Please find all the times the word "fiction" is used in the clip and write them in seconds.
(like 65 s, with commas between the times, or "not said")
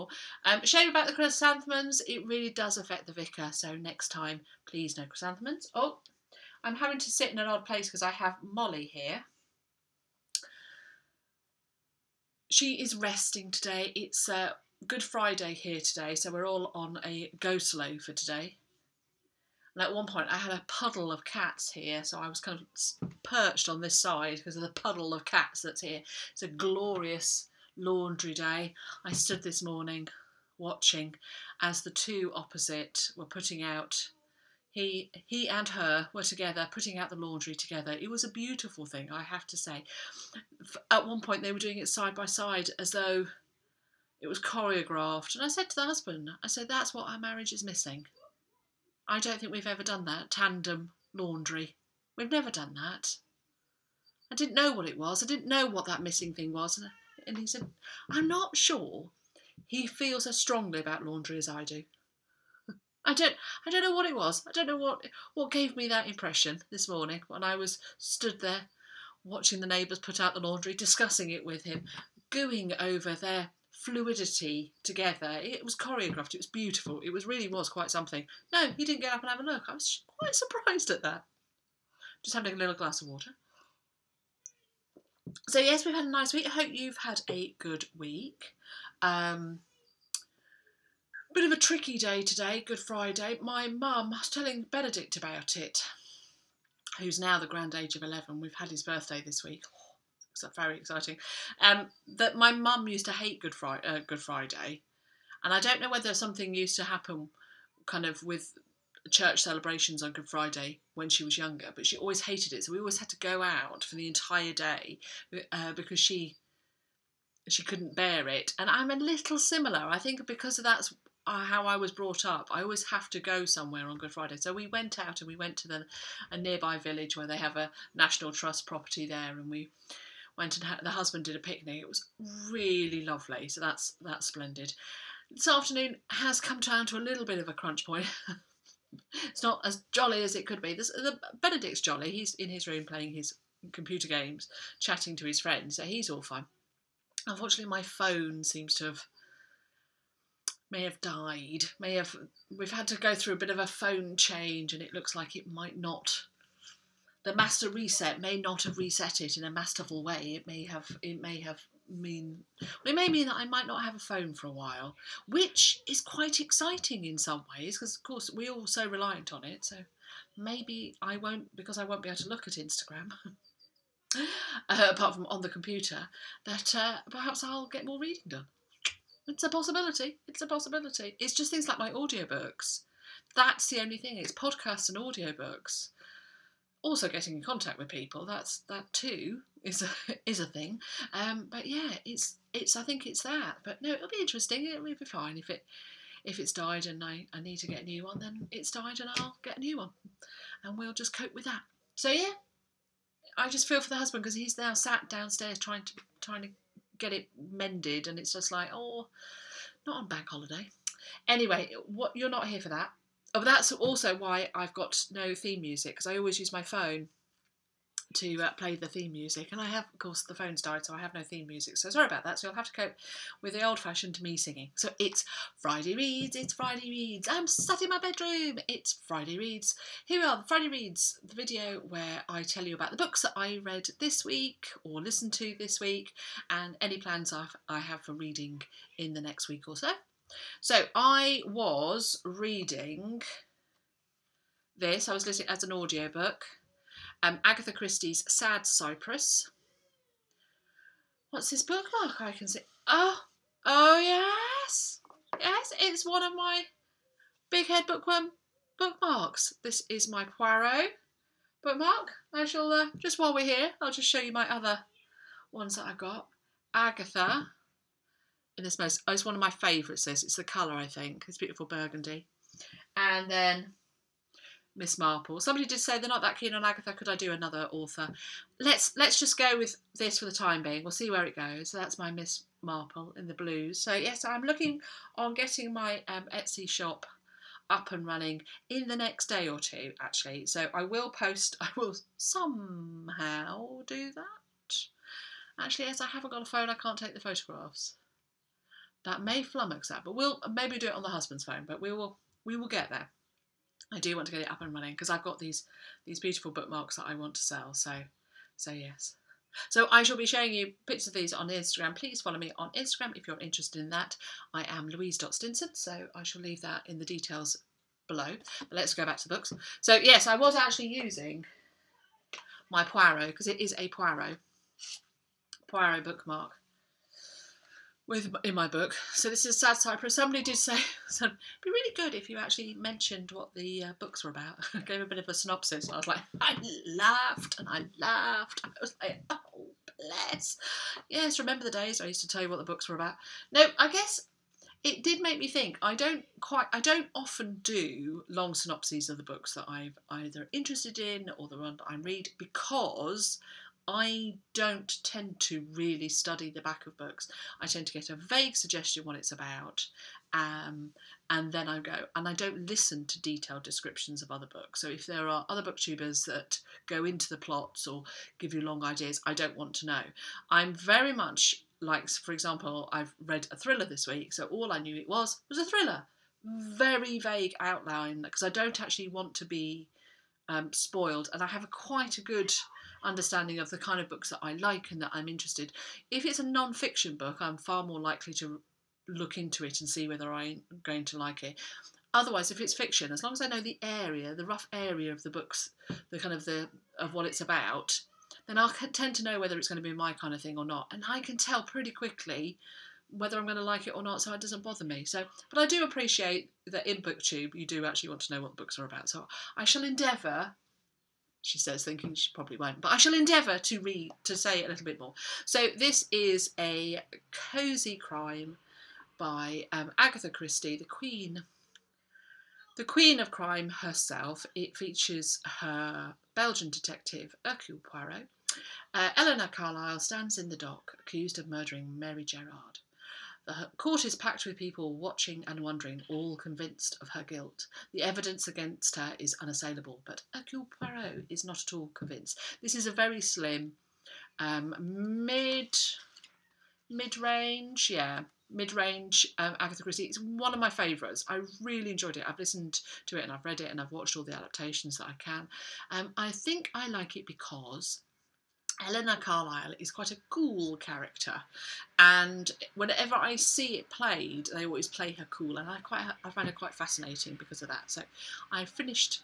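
386 s, 392 s.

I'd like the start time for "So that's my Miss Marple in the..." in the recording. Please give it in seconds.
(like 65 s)
281 s.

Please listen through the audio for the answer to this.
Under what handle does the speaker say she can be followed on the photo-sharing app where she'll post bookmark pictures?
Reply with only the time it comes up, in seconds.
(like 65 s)
314 s.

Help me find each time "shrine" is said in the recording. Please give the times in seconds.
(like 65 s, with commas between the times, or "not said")
not said.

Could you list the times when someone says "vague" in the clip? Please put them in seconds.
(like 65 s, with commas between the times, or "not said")
358 s, 377 s.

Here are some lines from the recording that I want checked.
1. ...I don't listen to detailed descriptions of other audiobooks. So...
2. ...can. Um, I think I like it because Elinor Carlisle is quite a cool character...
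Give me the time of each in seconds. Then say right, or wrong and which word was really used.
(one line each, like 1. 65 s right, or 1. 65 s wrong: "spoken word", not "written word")
1. 362 s wrong: "books", not "audiobooks"
2. 455 s right.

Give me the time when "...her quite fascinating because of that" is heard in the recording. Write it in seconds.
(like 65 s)
466 s.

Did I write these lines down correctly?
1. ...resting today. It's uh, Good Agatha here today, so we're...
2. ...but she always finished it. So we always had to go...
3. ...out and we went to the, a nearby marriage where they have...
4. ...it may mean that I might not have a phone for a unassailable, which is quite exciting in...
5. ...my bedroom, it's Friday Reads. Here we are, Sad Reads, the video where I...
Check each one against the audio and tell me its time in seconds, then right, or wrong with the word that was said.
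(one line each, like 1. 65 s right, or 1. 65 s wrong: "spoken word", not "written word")
1. 12 s wrong: "Friday", not "Agatha"
2. 111 s wrong: "hated", not "finished"
3. 124 s wrong: "village", not "marriage"
4. 162 s wrong: "while", not "unassailable"
5. 227 s wrong: "Friday", not "Sad".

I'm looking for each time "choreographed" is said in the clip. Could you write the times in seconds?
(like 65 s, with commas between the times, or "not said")
44 s, 75 s.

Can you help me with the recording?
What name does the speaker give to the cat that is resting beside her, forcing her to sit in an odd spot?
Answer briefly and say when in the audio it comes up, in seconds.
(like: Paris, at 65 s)
Molly, at 8 s.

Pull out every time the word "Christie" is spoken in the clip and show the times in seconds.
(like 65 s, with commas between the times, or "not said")
247 s, 420 s, 449 s.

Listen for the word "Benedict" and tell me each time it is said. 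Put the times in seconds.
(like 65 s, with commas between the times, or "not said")
94 s, 141 s.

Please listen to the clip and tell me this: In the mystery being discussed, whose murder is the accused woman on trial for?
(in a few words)
Mary Gerard.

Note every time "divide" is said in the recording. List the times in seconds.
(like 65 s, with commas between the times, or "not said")
not said.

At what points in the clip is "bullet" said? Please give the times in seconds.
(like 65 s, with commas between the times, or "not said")
not said.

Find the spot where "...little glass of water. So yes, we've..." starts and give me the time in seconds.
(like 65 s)
82 s.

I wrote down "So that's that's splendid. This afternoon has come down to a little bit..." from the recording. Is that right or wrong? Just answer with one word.
right.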